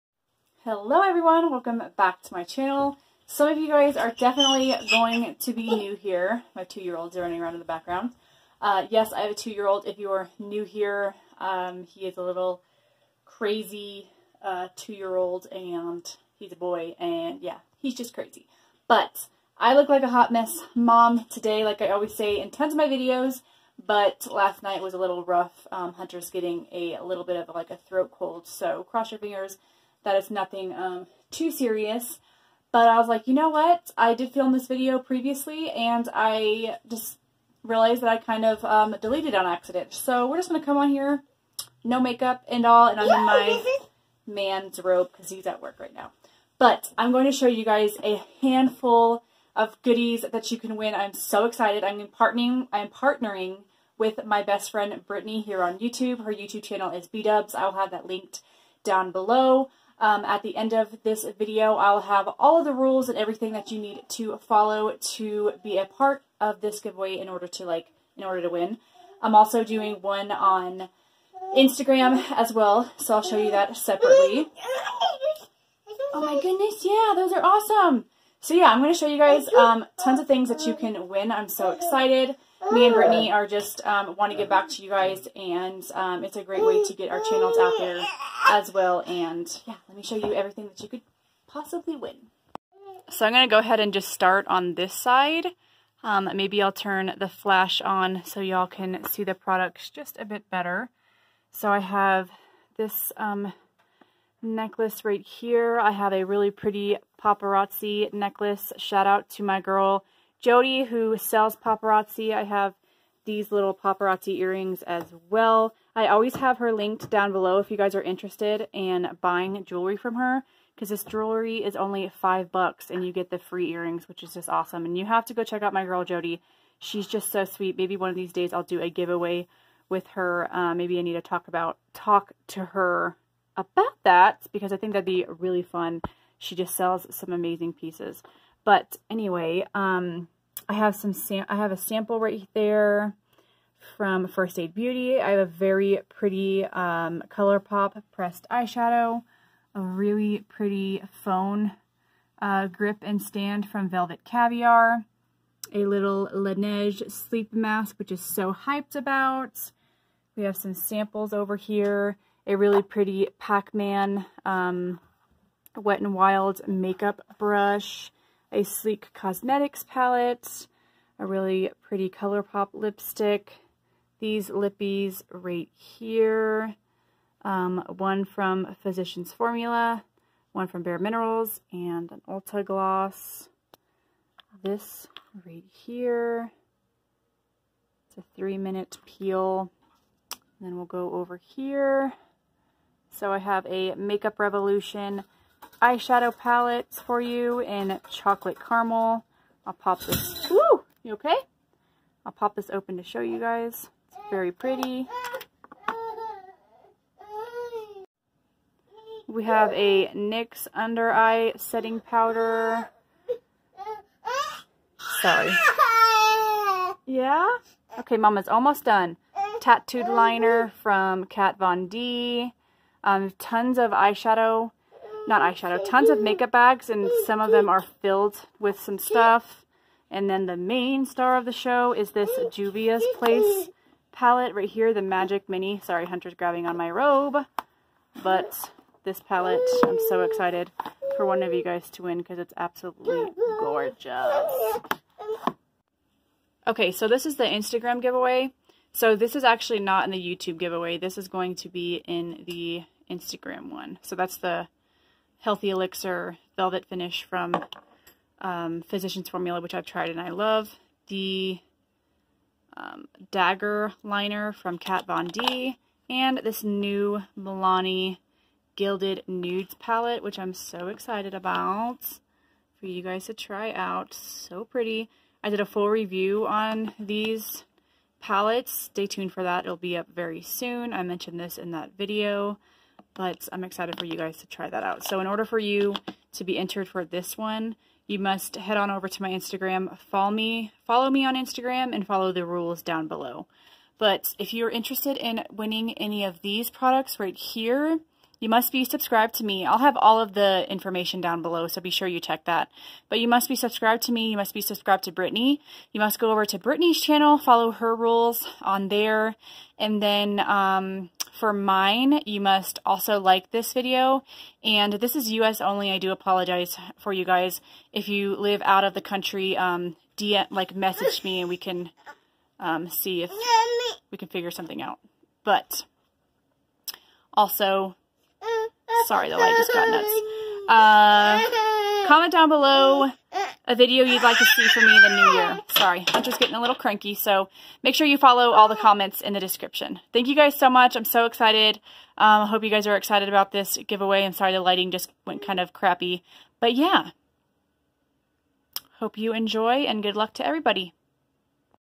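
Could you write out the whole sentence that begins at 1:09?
I'm also doing one on Instagram as well, so I'll show you that separately.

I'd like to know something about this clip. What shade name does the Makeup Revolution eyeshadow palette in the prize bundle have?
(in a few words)
Chocolate Caramel.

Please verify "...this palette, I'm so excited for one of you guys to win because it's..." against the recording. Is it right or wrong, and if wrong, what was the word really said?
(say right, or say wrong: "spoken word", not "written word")
right.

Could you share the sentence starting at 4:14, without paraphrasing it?
So that's the Healthy Elixir Velvet Finish from um, Physicians Formula, which I've tried and I love.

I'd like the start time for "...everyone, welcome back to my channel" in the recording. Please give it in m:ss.
0:01.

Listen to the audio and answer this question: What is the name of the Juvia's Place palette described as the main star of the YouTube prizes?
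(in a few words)
Magic Mini.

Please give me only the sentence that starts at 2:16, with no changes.
She just sells some amazing pieces.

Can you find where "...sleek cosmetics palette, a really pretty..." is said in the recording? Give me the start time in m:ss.
2:48.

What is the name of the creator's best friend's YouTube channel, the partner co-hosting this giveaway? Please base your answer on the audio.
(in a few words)
B-Dubs.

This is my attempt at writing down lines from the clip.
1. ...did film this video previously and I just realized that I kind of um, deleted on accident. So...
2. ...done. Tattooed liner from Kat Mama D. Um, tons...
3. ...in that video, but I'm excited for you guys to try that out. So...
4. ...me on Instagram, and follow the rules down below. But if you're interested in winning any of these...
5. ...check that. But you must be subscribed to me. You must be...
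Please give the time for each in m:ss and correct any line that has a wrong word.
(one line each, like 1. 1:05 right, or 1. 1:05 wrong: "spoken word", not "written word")
1. 0:34 right
2. 3:38 wrong: "Von", not "Mama"
3. 4:41 right
4. 4:51 right
5. 5:02 right.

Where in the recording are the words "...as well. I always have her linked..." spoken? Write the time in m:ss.
1:54.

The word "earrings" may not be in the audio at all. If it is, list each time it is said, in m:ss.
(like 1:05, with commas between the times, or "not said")
1:54, 2:03.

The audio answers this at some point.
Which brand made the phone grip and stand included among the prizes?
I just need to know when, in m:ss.
2:33.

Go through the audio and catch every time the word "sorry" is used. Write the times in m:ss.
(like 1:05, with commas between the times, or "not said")
3:35, 3:55, 5:29, 5:35, 5:44.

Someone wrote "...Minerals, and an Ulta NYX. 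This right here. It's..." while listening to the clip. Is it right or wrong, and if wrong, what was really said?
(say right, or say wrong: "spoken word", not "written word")
wrong: "Gloss", not "NYX".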